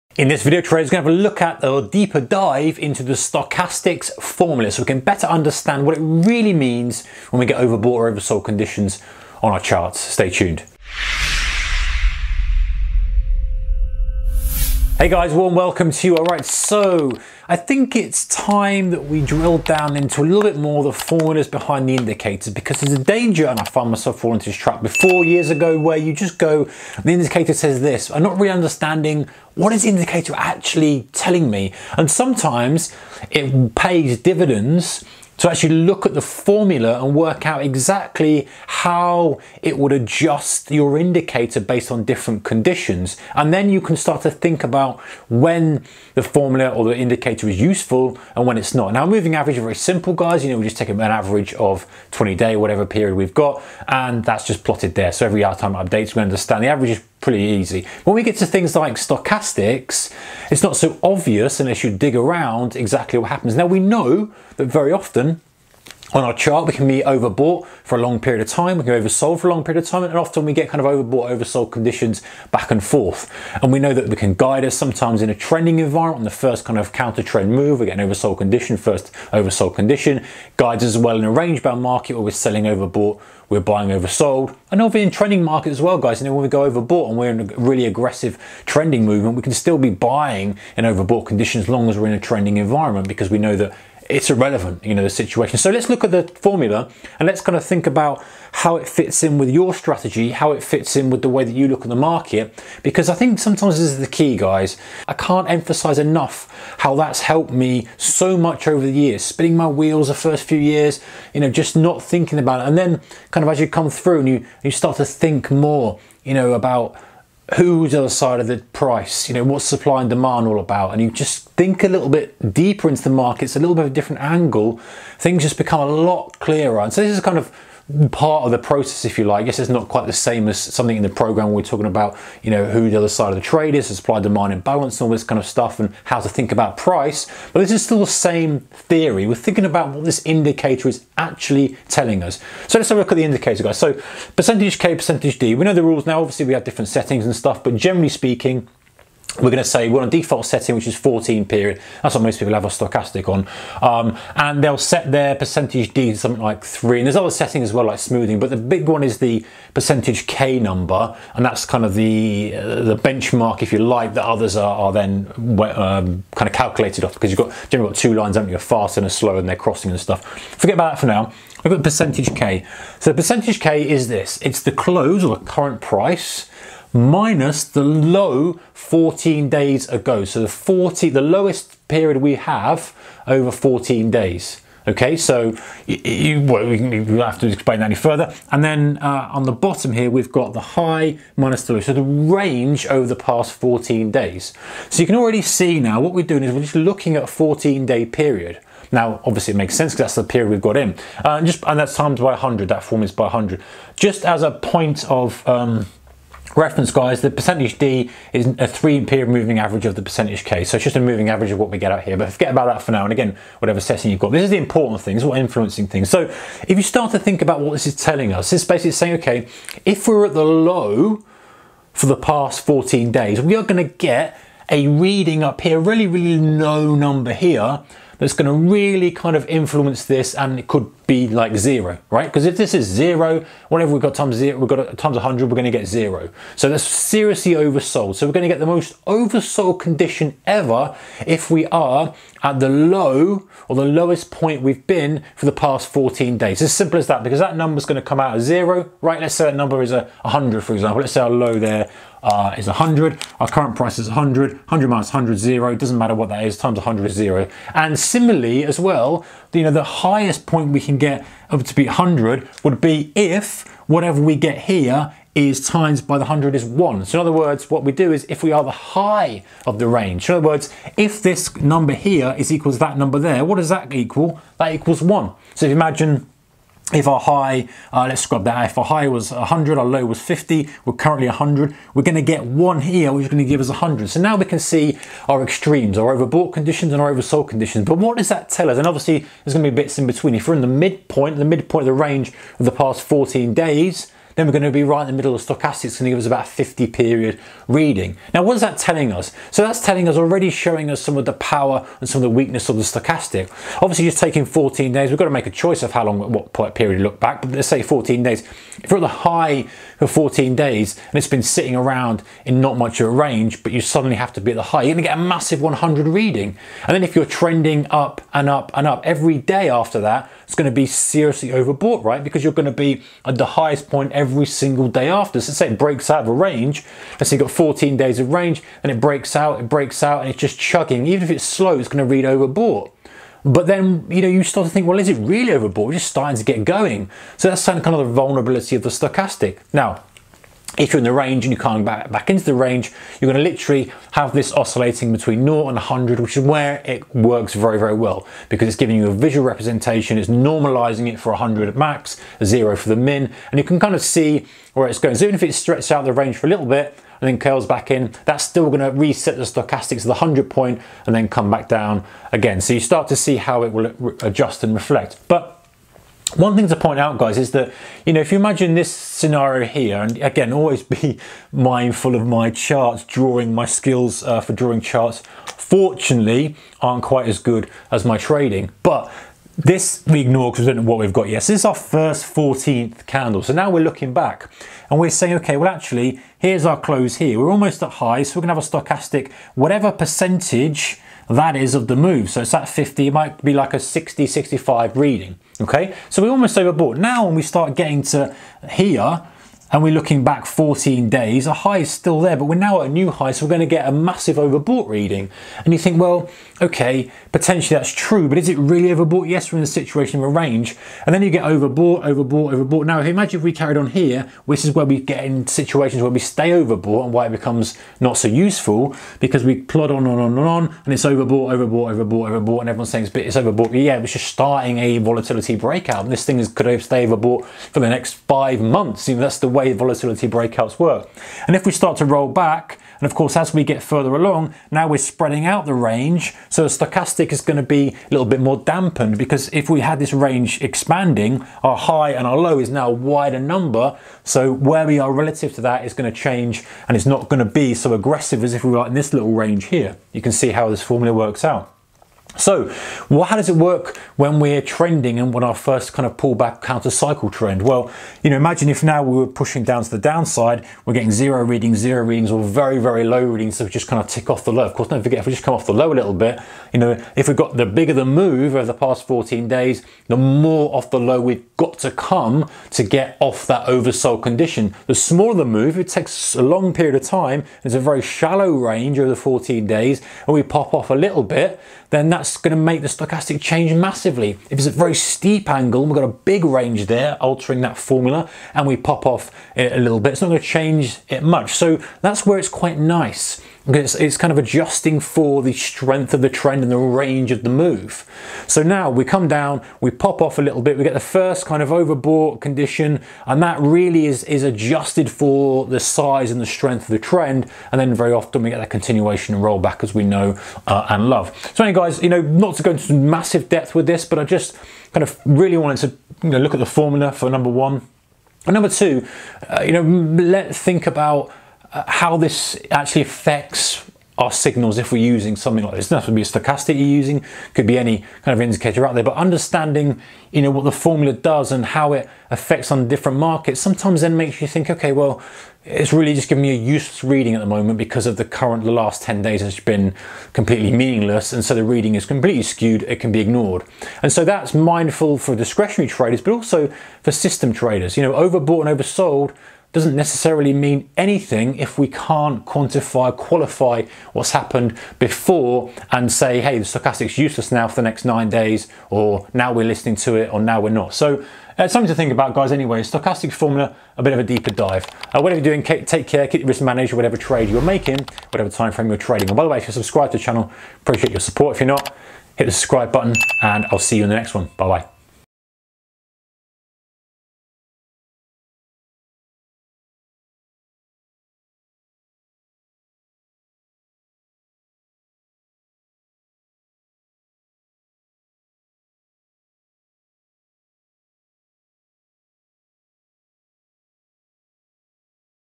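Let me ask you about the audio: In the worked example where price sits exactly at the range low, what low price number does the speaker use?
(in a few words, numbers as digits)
100.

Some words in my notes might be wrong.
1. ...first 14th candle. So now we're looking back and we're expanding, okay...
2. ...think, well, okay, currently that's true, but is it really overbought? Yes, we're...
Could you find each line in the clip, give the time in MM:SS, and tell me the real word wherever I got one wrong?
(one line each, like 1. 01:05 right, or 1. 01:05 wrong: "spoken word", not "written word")
1. 06:21 wrong: "saying", not "expanding"
2. 06:45 wrong: "potentially", not "currently".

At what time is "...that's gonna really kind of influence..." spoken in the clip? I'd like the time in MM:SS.
03:48.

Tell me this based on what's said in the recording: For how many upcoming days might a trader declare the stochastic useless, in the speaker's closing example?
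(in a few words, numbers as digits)
9.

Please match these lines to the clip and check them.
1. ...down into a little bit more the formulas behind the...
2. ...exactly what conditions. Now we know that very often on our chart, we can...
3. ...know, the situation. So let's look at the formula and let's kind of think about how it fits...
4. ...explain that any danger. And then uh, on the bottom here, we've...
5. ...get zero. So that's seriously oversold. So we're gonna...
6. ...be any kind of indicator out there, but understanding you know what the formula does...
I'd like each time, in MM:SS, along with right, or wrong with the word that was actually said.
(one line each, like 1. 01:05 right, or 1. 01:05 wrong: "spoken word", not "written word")
1. 00:19 right
2. 01:02 wrong: "happens", not "conditions"
3. 01:34 right
4. 03:07 wrong: "further", not "danger"
5. 03:55 right
6. 08:47 right.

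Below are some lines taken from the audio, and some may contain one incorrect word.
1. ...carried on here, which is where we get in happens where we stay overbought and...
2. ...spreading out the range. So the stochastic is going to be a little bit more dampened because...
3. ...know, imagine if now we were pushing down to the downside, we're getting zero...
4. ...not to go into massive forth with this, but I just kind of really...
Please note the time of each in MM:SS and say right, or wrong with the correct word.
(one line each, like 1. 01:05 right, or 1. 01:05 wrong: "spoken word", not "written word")
1. 06:53 wrong: "situations", not "happens"
2. 07:15 right
3. 07:38 right
4. 08:32 wrong: "depth", not "forth".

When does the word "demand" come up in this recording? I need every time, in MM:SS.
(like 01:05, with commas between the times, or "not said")
02:00, 02:14.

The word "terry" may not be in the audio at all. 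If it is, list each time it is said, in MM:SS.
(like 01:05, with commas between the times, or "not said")
not said.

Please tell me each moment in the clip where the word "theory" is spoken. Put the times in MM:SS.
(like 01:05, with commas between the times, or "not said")
02:18.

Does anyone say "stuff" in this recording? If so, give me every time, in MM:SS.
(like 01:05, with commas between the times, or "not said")
02:15, 02:27, 02:49.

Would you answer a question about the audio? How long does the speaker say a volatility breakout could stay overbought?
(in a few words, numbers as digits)
five months.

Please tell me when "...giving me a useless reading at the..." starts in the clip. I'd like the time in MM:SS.
08:56.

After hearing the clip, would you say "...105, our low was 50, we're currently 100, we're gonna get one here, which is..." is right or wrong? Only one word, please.
wrong.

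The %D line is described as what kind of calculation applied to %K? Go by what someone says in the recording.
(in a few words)
three period moving average.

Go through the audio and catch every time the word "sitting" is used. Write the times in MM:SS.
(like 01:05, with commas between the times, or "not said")
05:11.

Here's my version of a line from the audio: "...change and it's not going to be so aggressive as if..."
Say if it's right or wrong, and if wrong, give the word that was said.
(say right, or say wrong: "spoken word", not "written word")
right.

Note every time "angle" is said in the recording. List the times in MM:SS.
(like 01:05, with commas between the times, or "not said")
02:04, 08:05.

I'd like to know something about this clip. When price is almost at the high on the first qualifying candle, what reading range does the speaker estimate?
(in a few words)
60 to 65.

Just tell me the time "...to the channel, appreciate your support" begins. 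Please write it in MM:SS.
09:30.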